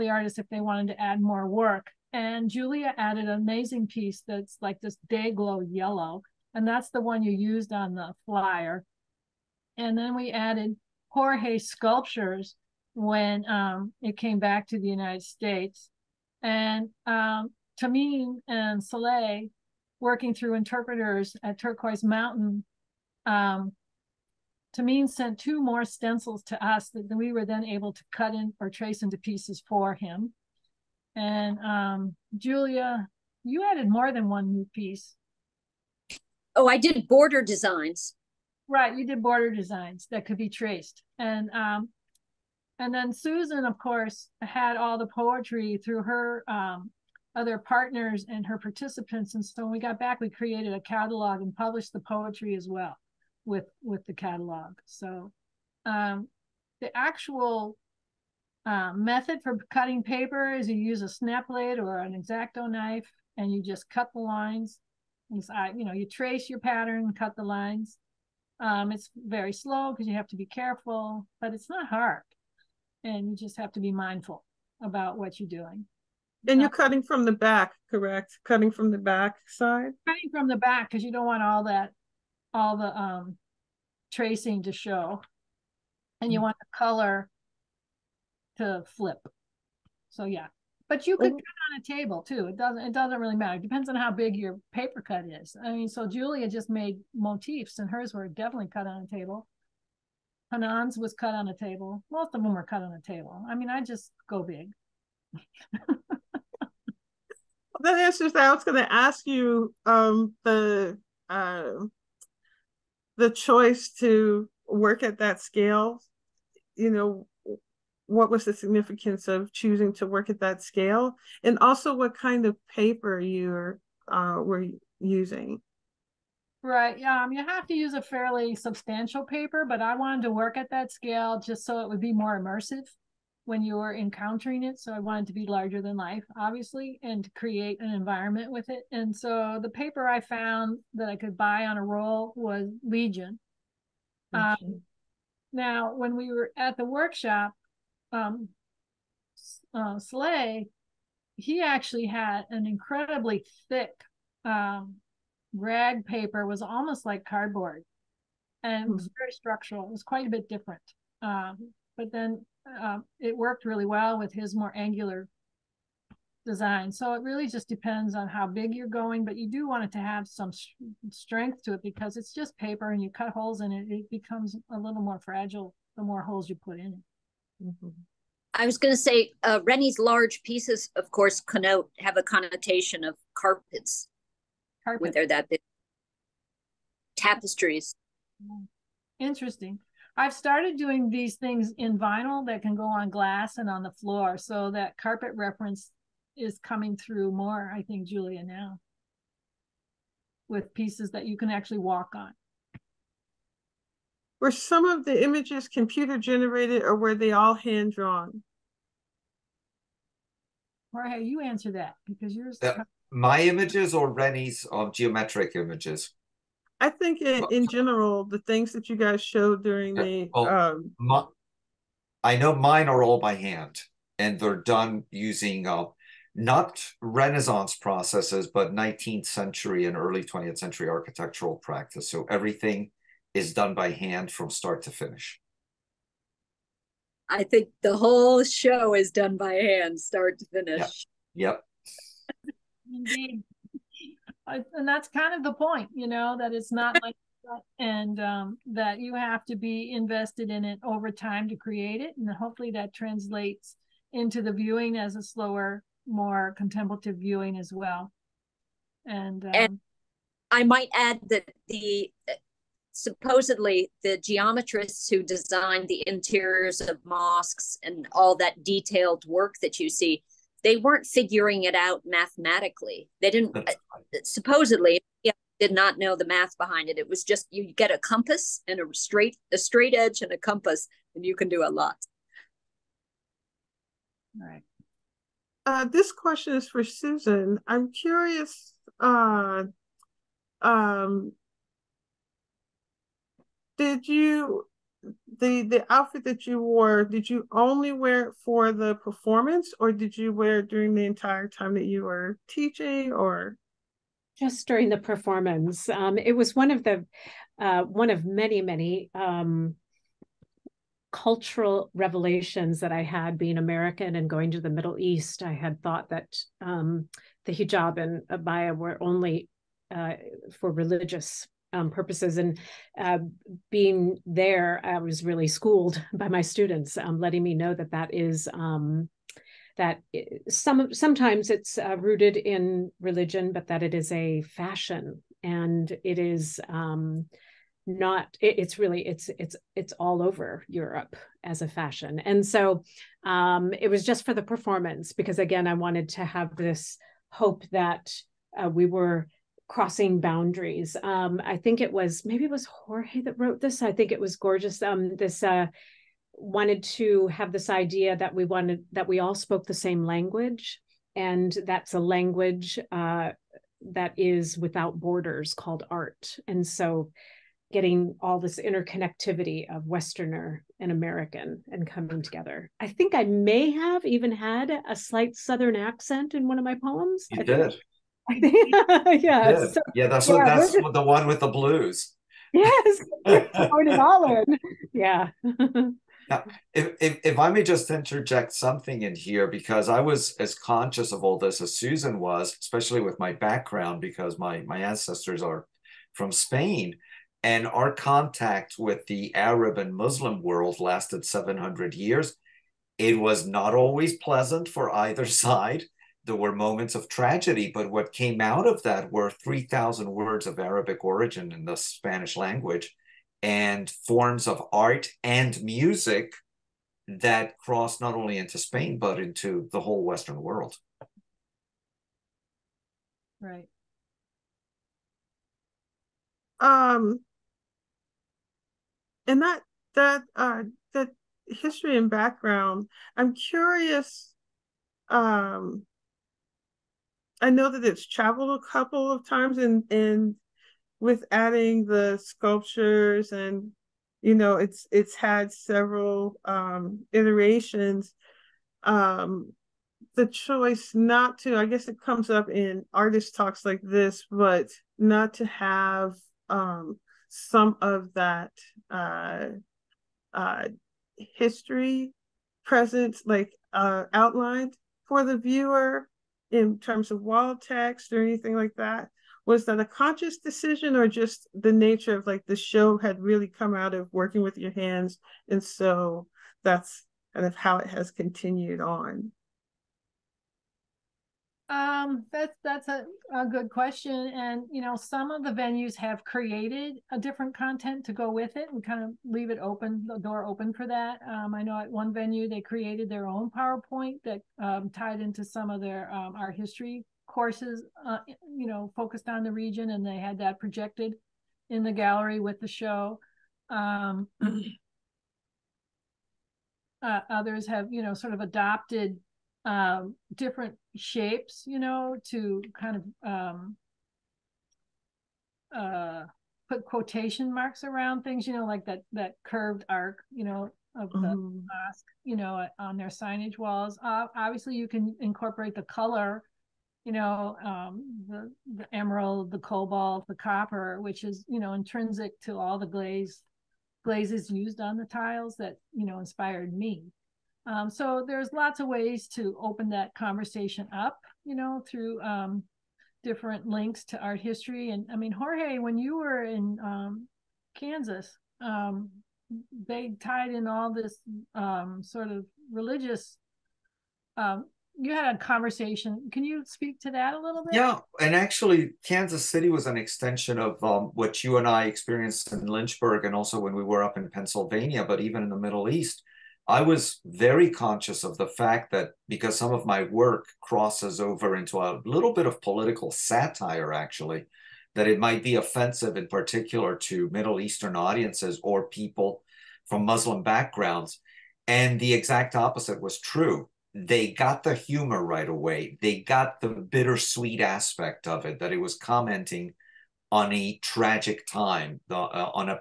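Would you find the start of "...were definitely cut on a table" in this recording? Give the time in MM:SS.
01:38.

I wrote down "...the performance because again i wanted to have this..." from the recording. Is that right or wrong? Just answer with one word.
right.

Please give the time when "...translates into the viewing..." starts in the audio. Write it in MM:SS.
04:12.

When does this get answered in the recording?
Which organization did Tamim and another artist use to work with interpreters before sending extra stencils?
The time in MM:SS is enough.
00:21.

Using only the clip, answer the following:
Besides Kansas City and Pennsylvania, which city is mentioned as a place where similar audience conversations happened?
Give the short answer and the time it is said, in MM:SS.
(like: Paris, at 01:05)
Lynchburg, at 09:22.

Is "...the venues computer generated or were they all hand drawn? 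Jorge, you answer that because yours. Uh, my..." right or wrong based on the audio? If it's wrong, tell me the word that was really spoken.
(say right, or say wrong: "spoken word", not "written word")
wrong: "images", not "venues".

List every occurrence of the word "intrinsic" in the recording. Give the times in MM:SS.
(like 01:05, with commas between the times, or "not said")
08:51.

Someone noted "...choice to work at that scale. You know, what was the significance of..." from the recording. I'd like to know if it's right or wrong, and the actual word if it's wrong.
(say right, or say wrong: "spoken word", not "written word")
right.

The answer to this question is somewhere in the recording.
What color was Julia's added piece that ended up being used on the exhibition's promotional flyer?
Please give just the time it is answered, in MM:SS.
00:05.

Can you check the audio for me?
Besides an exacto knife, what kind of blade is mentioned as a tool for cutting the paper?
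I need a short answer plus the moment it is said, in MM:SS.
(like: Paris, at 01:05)
Snap blade, at 01:01.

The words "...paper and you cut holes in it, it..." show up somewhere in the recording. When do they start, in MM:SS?
02:52.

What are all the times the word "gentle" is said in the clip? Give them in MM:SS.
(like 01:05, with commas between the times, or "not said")
not said.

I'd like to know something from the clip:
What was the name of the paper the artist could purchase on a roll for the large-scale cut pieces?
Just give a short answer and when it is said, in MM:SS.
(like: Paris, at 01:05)
Legion, at 02:22.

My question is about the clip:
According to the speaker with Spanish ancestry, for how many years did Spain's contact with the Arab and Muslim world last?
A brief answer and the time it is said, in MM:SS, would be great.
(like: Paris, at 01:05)
700 years, at 06:41.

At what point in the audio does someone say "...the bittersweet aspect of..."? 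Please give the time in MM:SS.
09:46.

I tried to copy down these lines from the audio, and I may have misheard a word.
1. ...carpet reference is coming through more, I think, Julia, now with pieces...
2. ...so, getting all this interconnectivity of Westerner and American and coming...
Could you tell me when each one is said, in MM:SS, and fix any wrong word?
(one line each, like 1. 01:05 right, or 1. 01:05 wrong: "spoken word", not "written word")
1. 03:14 right
2. 06:06 right.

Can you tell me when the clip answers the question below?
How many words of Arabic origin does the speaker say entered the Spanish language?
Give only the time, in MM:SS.
06:49.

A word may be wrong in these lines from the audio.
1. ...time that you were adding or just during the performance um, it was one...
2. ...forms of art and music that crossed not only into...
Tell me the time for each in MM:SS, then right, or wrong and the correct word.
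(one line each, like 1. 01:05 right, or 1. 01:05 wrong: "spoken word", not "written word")
1. 05:01 wrong: "teaching", not "adding"
2. 06:53 right.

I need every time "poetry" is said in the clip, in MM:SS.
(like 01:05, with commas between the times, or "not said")
00:45, 00:52.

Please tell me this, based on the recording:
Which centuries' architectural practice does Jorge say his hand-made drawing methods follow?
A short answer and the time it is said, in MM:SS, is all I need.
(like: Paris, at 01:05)
19th and early 20th century, at 03:48.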